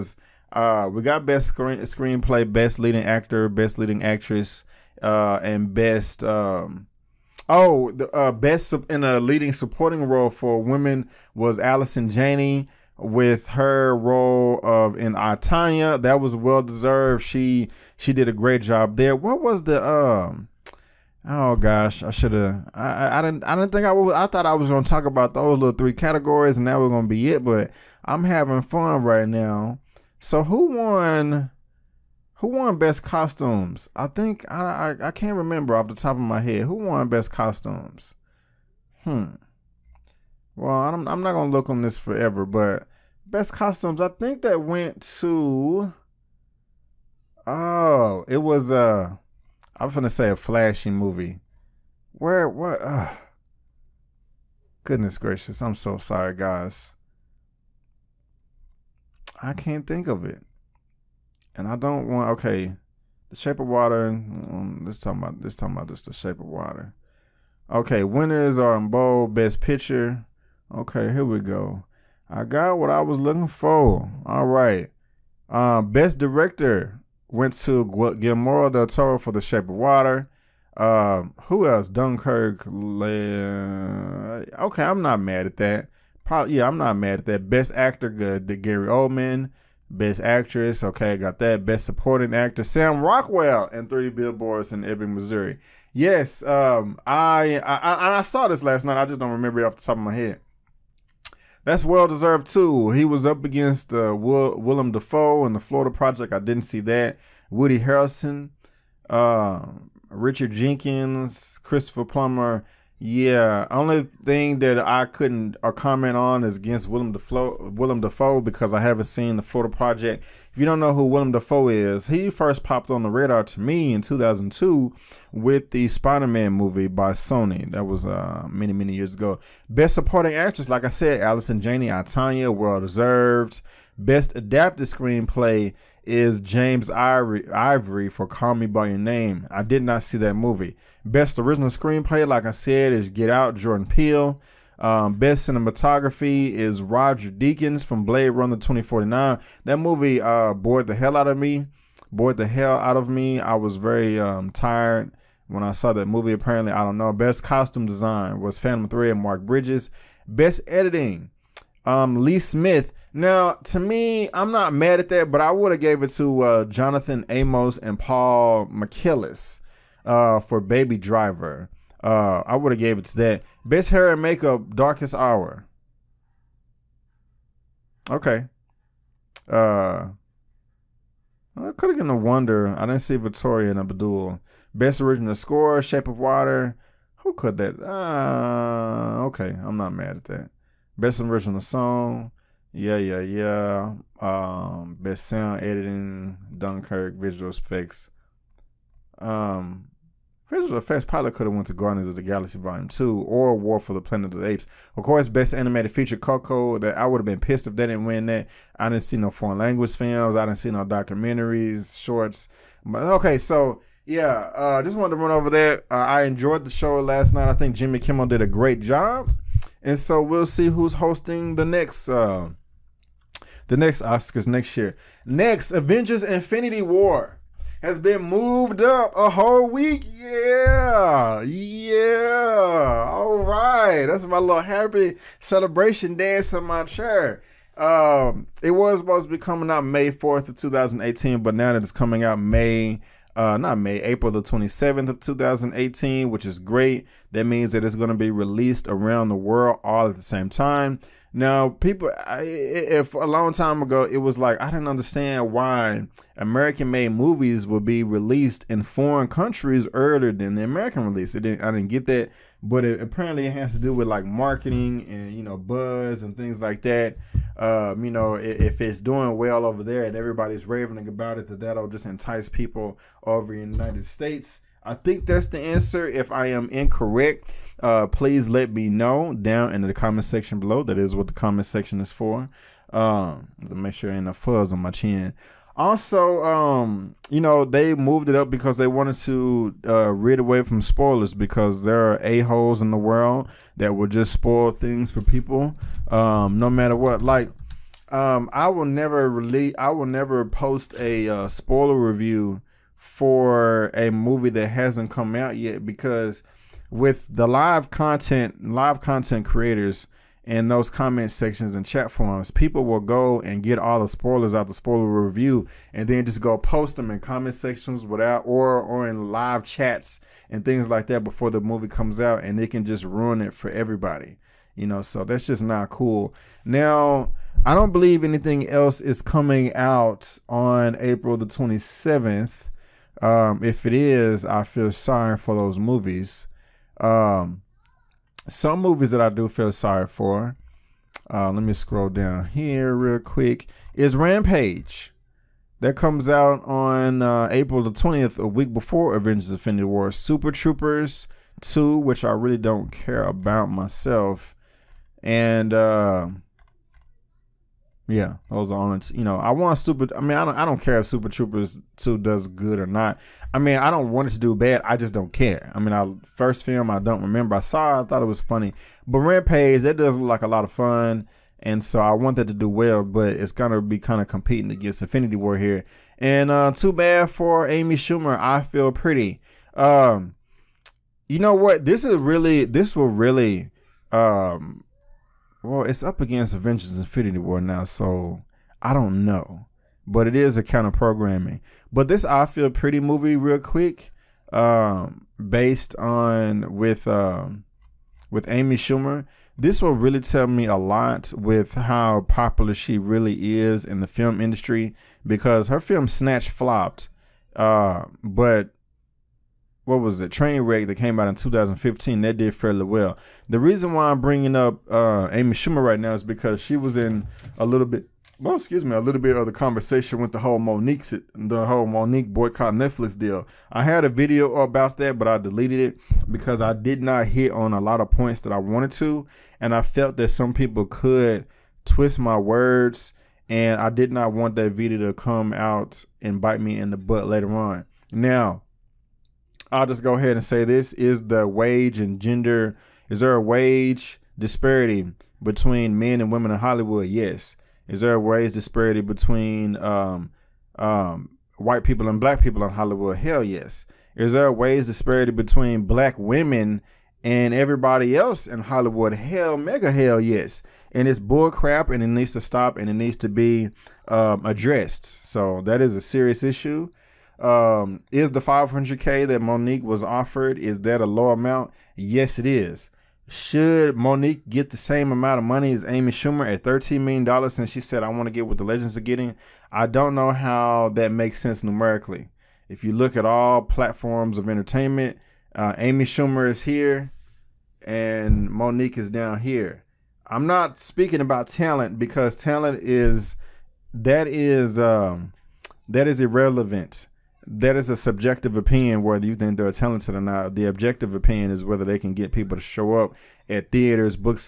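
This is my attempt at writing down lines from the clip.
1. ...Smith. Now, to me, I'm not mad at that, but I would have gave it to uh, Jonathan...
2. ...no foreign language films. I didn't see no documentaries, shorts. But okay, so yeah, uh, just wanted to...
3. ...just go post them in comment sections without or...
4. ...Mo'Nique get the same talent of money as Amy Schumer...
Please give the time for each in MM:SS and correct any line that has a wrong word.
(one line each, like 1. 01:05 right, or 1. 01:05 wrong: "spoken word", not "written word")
1. 02:42 right
2. 03:29 right
3. 05:16 right
4. 07:53 wrong: "amount", not "talent".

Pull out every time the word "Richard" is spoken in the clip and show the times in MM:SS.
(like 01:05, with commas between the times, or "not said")
01:50.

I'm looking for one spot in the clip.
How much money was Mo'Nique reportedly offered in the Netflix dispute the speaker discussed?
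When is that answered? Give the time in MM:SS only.
07:48.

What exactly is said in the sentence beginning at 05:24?
You know, so that's just not cool.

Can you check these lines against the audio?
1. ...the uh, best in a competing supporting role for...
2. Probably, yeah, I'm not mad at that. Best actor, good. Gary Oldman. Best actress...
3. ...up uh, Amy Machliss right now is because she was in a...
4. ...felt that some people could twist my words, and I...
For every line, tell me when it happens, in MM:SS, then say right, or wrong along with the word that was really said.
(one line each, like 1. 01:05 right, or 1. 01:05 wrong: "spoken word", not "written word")
1. 00:07 wrong: "leading", not "competing"
2. 01:26 right
3. 06:54 wrong: "Schumer", not "Machliss"
4. 07:09 right.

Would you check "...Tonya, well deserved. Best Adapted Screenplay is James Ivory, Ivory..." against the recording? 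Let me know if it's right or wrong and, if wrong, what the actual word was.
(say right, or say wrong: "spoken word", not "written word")
right.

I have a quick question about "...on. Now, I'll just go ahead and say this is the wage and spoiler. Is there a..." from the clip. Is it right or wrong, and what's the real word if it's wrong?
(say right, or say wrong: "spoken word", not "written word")
wrong: "gender", not "spoiler".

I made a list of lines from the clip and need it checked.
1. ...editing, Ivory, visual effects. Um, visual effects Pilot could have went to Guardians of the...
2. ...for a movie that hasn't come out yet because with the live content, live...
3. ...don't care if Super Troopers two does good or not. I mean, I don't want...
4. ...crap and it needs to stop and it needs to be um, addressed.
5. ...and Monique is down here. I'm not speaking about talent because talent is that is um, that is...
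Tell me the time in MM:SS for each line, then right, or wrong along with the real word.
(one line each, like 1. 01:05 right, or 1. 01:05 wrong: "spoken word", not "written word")
1. 03:15 wrong: "Dunkirk", not "Ivory"
2. 05:02 right
3. 06:00 right
4. 07:41 right
5. 08:07 right.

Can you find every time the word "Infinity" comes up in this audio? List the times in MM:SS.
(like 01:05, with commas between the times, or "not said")
03:46, 05:49, 06:15, 06:26.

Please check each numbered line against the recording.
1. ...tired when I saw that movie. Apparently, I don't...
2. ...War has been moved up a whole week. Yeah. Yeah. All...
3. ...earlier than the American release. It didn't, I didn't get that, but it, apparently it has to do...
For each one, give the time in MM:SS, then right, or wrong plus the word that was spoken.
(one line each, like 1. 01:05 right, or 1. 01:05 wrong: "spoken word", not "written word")
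1. 02:34 right
2. 03:46 right
3. 04:19 right.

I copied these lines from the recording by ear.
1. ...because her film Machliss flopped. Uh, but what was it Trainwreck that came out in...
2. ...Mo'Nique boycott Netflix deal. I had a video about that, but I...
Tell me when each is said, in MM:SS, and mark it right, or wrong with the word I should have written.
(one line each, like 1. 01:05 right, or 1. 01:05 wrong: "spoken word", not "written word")
1. 06:45 wrong: "Snatch", not "Machliss"
2. 07:01 right.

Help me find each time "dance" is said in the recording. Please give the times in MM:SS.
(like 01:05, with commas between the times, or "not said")
03:56.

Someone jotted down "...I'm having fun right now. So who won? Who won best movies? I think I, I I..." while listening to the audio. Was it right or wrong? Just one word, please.
wrong.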